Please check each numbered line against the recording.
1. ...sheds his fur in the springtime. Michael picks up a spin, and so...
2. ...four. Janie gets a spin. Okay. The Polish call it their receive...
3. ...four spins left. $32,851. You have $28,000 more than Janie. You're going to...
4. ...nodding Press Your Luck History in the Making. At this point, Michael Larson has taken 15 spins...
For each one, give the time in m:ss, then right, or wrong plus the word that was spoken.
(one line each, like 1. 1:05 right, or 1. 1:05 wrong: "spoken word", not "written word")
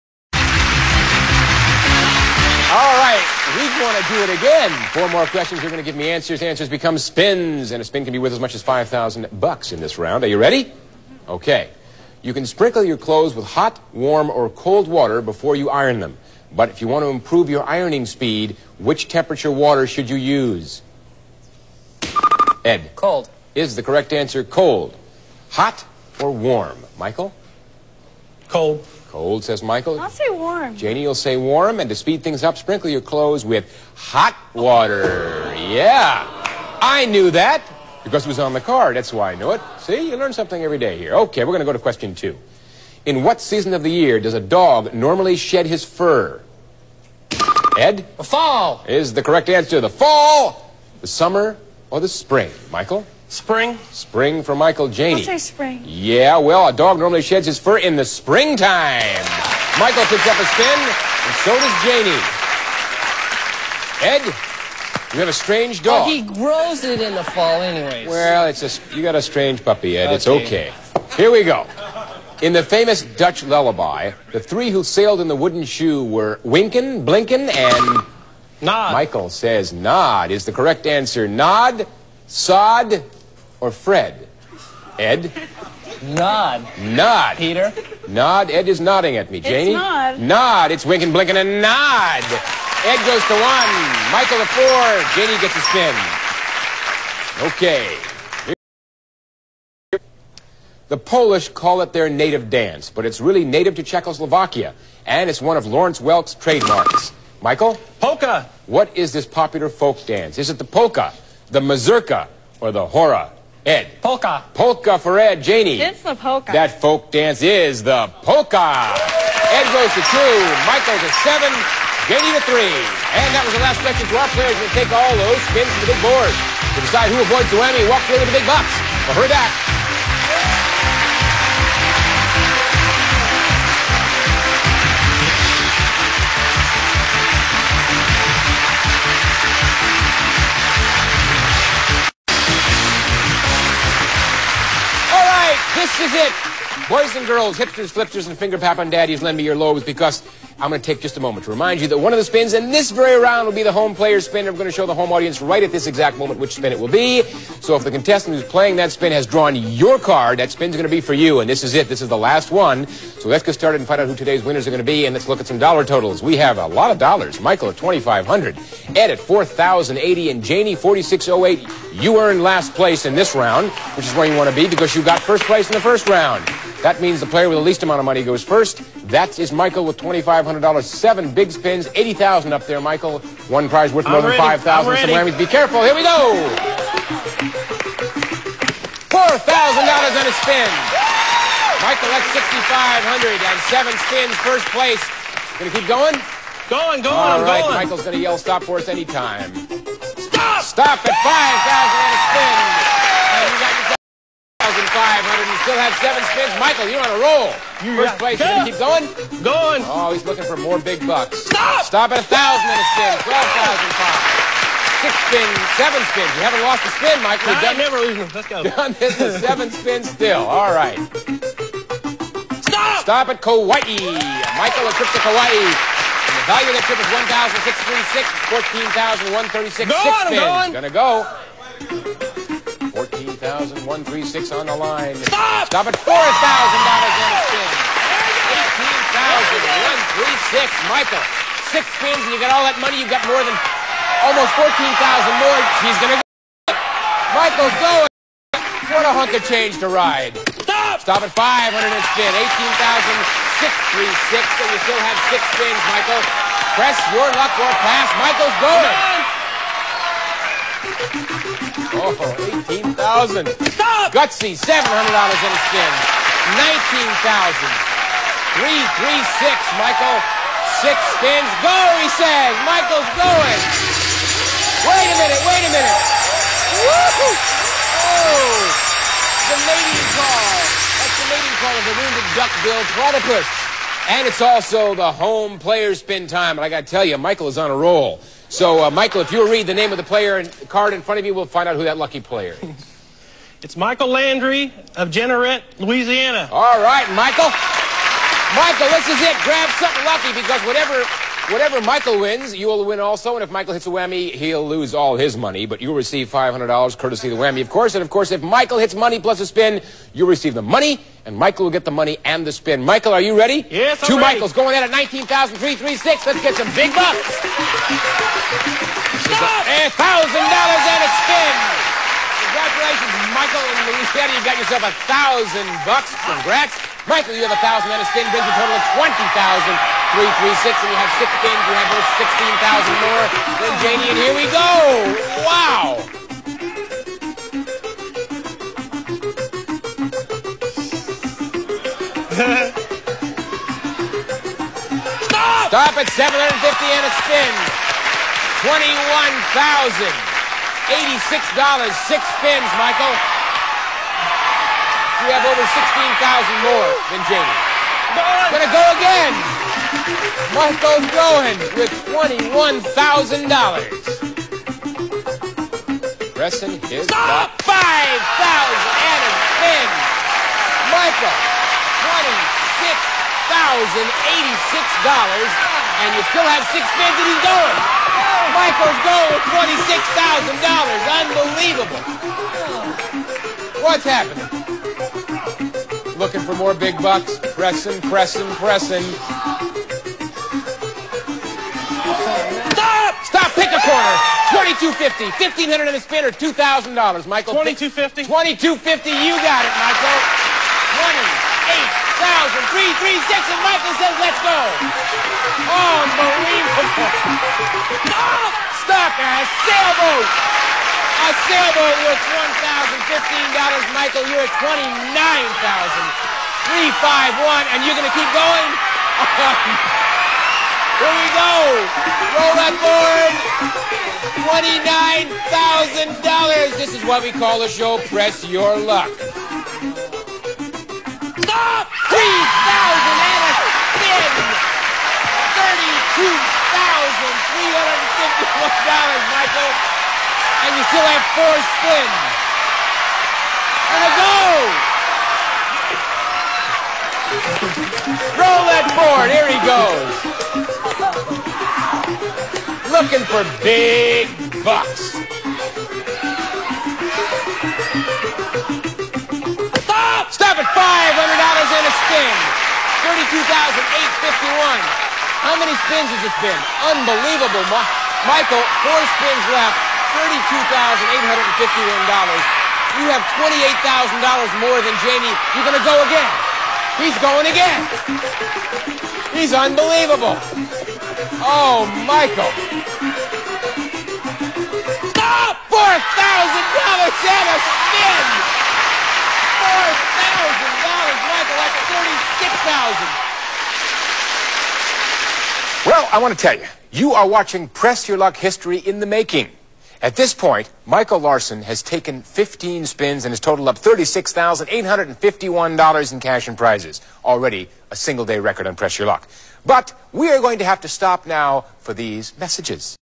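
1. 0:57 right
2. 1:34 wrong: "native", not "receive"
3. 7:48 right
4. 8:17 wrong: "watching", not "nodding".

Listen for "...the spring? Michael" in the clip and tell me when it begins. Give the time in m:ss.
0:51.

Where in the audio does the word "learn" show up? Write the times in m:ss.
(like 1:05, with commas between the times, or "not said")
0:40.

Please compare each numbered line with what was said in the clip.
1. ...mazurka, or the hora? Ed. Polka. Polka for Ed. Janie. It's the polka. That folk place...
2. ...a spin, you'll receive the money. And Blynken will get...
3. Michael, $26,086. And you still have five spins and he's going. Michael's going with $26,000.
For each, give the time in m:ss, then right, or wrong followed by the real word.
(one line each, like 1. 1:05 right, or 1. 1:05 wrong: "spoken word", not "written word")
1. 1:51 wrong: "dance", not "place"
2. 5:09 wrong: "Michael", not "Blynken"
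3. 6:10 wrong: "six", not "five".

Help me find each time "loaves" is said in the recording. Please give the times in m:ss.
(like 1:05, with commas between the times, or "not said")
2:29.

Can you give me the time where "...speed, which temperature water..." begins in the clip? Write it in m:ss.
0:18.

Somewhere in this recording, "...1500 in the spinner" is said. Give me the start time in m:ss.
6:35.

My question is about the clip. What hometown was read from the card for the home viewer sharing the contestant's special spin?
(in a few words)
Jeanerette, Louisiana.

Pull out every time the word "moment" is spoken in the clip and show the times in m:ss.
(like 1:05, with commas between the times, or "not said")
2:31, 2:36.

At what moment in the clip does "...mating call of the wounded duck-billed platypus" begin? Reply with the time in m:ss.
4:41.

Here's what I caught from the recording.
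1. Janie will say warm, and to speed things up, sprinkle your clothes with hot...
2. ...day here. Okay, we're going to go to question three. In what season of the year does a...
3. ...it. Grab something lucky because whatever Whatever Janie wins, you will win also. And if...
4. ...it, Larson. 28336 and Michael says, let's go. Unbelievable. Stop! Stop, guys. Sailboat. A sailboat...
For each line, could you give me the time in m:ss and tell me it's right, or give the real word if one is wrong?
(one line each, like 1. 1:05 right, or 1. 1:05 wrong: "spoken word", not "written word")
1. 0:30 right
2. 0:40 wrong: "two", not "three"
3. 4:59 wrong: "Michael", not "Janie"
4. 6:39 wrong: "Michael", not "Larson".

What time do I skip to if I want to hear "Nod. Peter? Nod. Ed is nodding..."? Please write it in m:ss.
1:26.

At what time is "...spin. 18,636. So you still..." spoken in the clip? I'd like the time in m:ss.
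4:12.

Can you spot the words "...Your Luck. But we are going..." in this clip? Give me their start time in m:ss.
8:28.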